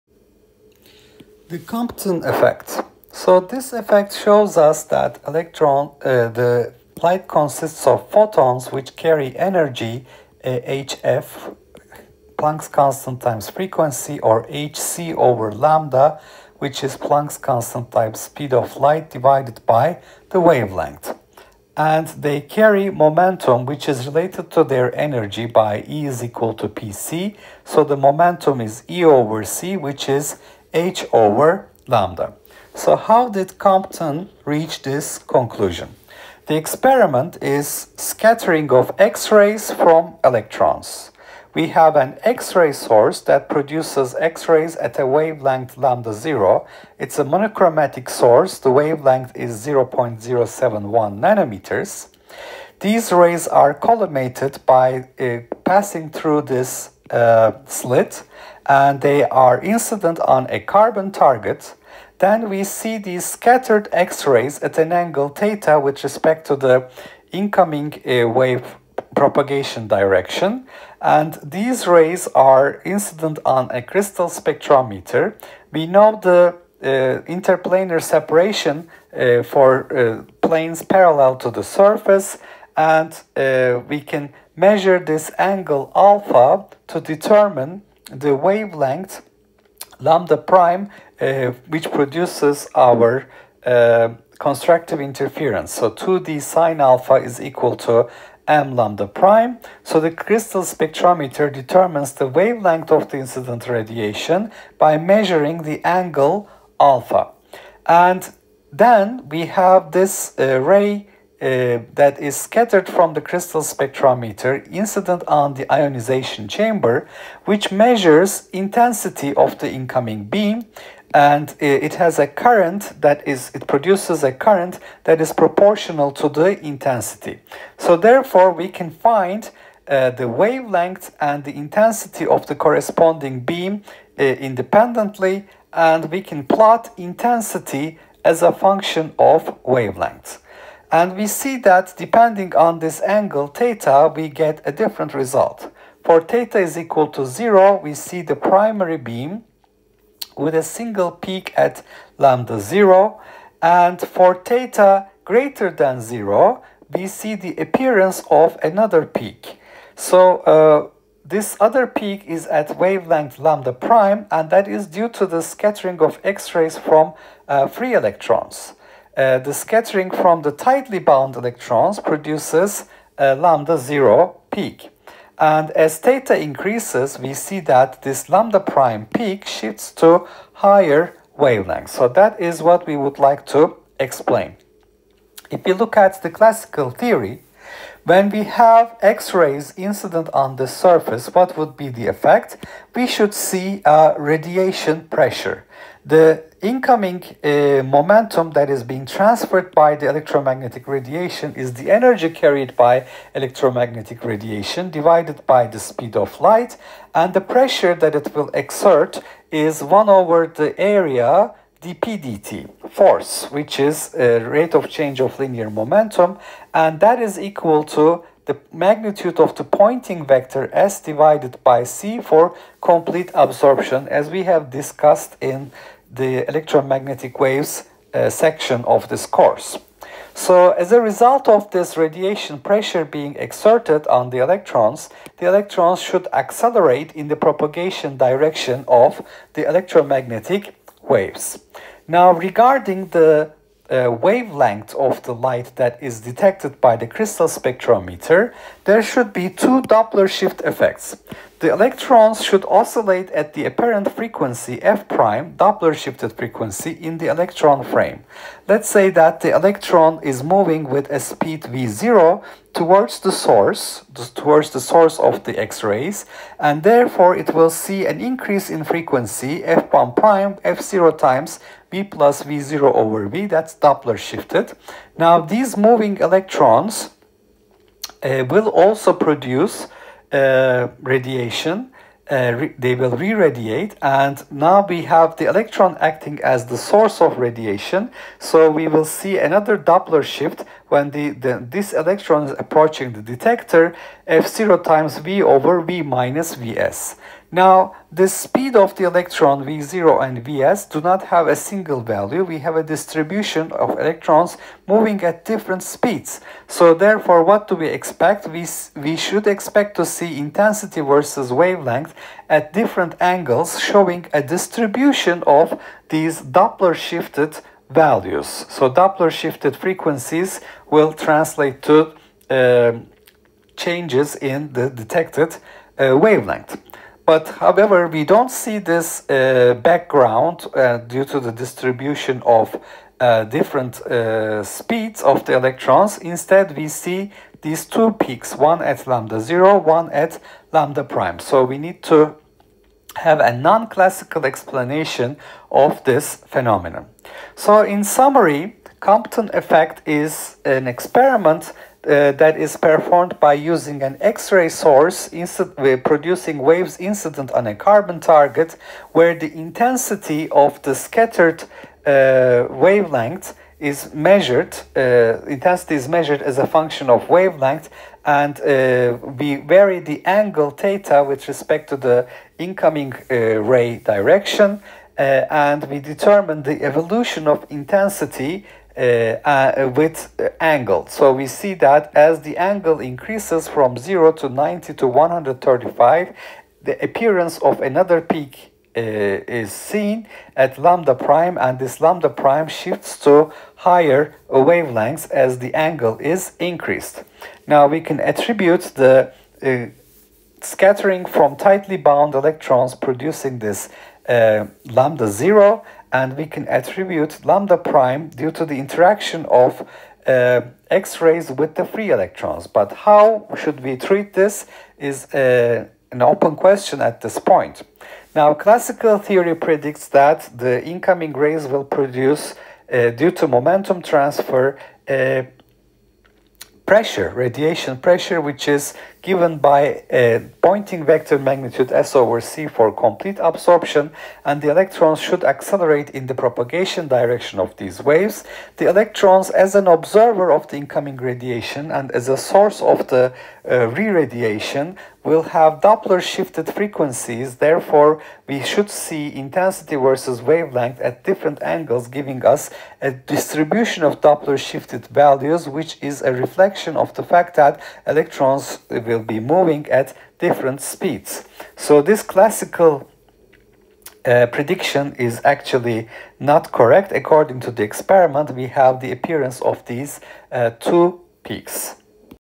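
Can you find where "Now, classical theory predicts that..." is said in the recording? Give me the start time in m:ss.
6:58.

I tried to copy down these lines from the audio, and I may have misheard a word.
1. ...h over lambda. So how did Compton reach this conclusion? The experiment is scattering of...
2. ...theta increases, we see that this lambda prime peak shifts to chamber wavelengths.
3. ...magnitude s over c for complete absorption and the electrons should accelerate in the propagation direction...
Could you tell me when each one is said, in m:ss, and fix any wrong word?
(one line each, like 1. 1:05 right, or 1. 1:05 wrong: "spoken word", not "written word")
1. 0:30 right
2. 2:55 wrong: "higher", not "chamber"
3. 7:11 right.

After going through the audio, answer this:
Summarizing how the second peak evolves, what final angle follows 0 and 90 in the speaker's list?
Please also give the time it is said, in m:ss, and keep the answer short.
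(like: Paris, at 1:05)
135, at 6:25.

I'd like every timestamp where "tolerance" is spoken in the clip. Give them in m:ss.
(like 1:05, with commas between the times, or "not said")
not said.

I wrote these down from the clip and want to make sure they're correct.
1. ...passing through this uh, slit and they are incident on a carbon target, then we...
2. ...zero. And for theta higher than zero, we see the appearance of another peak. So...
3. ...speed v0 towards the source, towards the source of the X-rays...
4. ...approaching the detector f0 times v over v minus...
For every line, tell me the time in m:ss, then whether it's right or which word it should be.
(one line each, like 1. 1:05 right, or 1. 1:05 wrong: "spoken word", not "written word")
1. 0:55 right
2. 2:32 wrong: "greater", not "higher"
3. 4:21 right
4. 4:52 right.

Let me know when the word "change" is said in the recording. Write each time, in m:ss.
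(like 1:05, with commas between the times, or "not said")
3:34, 5:23.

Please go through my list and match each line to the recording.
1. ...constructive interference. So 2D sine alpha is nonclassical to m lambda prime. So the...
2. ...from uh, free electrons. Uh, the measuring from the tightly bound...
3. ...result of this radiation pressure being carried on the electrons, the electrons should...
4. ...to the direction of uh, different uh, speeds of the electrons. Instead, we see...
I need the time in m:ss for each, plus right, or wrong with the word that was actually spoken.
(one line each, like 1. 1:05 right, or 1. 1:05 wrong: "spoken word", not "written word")
1. 1:34 wrong: "equal", not "nonclassical"
2. 2:46 wrong: "scattering", not "measuring"
3. 3:51 wrong: "exerted", not "carried"
4. 5:31 wrong: "distribution", not "direction".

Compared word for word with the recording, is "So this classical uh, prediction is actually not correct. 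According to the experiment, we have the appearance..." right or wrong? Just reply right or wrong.
right.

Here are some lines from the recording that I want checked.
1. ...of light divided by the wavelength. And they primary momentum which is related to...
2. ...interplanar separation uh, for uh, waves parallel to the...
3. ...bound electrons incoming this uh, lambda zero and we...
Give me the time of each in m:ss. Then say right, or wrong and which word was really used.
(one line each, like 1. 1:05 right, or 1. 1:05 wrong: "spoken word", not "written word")
1. 0:18 wrong: "carry", not "primary"
2. 1:17 wrong: "planes", not "waves"
3. 6:41 wrong: "producing", not "incoming".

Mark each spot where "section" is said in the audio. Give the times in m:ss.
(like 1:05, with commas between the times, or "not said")
3:48.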